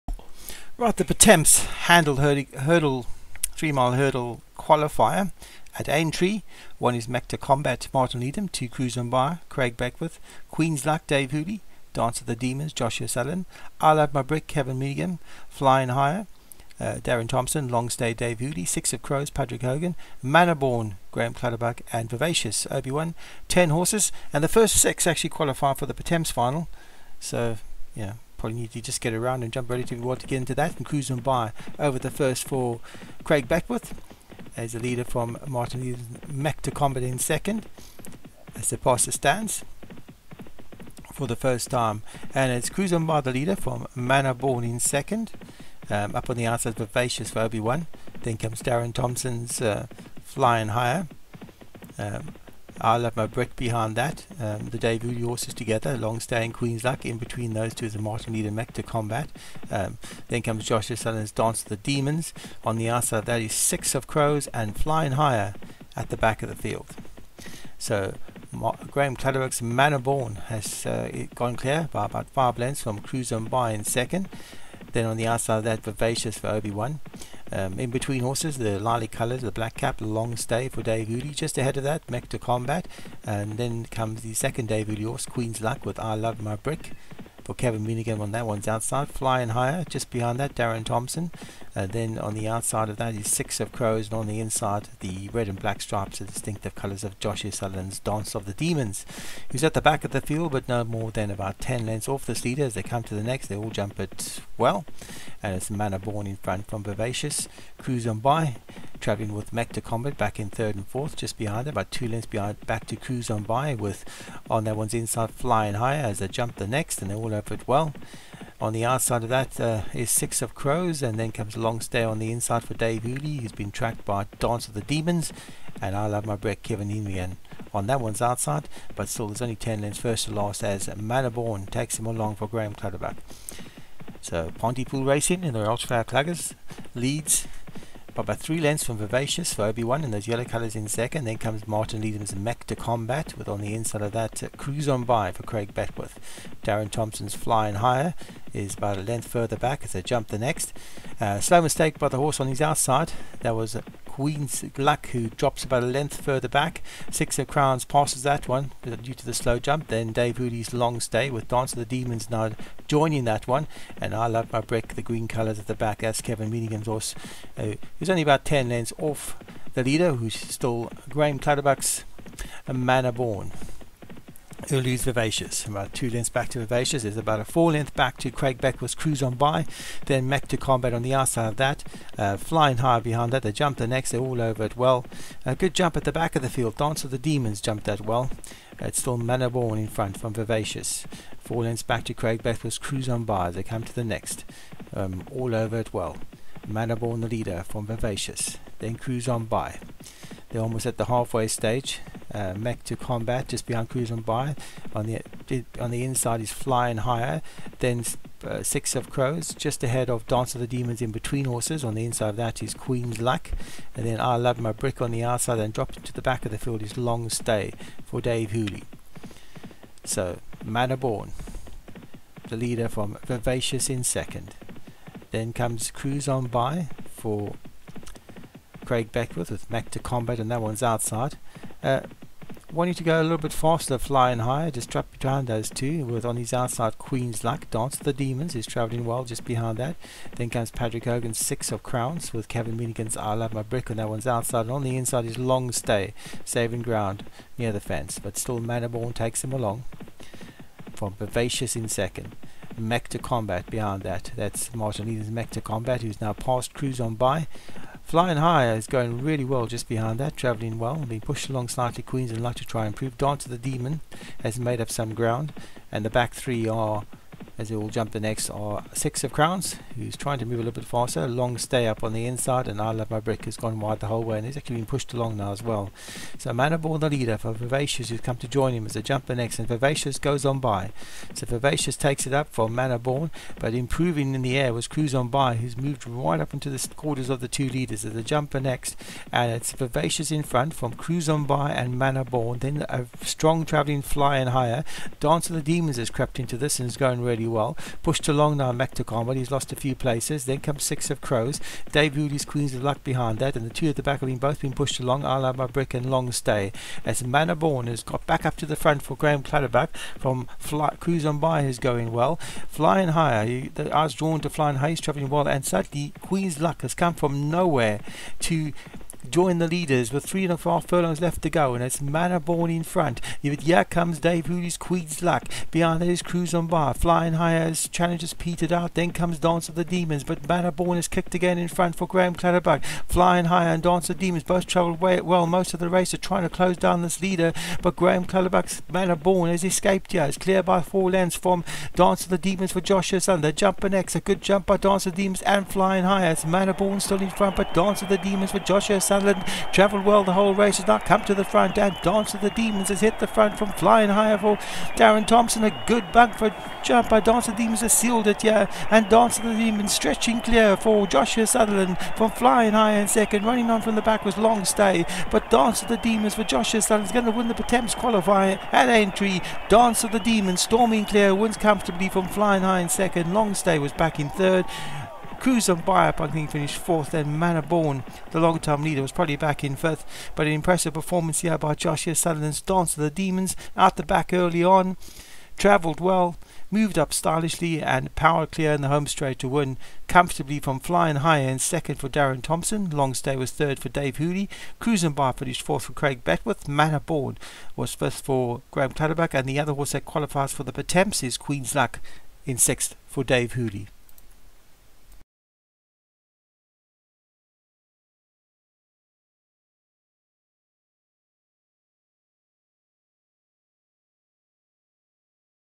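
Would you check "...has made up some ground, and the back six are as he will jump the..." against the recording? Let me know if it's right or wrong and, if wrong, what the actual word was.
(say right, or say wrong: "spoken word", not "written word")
wrong: "three", not "six".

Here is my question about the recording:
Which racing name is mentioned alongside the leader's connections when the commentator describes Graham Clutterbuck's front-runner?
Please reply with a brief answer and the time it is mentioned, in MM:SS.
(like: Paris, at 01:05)
Pontypool Racing, at 02:14.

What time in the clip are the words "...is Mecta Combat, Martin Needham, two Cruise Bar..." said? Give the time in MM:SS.
00:06.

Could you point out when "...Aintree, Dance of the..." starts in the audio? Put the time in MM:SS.
06:08.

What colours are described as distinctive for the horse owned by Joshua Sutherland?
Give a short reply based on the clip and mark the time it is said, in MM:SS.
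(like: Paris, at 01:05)
Red and black stripes, at 01:35.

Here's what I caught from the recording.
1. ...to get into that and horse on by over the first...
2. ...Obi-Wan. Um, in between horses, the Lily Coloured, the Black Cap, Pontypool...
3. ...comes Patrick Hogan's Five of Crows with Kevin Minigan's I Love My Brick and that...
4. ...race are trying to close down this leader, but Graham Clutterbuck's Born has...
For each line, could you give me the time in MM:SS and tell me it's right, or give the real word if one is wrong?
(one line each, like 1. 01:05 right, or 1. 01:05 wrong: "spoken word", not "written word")
1. 00:30 wrong: "cruise", not "horse"
2. 01:16 wrong: "Long", not "Pontypool"
3. 04:00 wrong: "Six", not "Five"
4. 05:35 right.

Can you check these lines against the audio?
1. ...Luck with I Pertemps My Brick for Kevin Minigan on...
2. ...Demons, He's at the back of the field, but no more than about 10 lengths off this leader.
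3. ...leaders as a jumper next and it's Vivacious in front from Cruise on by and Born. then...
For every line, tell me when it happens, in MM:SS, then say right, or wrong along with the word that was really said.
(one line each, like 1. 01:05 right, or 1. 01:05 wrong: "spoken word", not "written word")
1. 01:25 wrong: "Love", not "Pertemps"
2. 01:38 right
3. 04:47 right.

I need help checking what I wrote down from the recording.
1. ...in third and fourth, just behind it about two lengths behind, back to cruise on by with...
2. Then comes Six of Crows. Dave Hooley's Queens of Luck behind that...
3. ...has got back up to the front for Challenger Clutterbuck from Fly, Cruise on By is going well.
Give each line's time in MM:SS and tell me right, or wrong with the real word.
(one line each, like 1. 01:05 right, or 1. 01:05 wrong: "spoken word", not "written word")
1. 01:50 right
2. 05:00 right
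3. 05:07 wrong: "Graham", not "Challenger".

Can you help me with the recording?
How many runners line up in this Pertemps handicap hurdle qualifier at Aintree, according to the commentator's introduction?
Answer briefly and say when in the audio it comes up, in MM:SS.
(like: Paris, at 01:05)
10, at 00:23.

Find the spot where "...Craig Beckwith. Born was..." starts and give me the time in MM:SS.
06:35.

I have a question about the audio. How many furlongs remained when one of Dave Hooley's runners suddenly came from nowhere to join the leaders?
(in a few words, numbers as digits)
3.5.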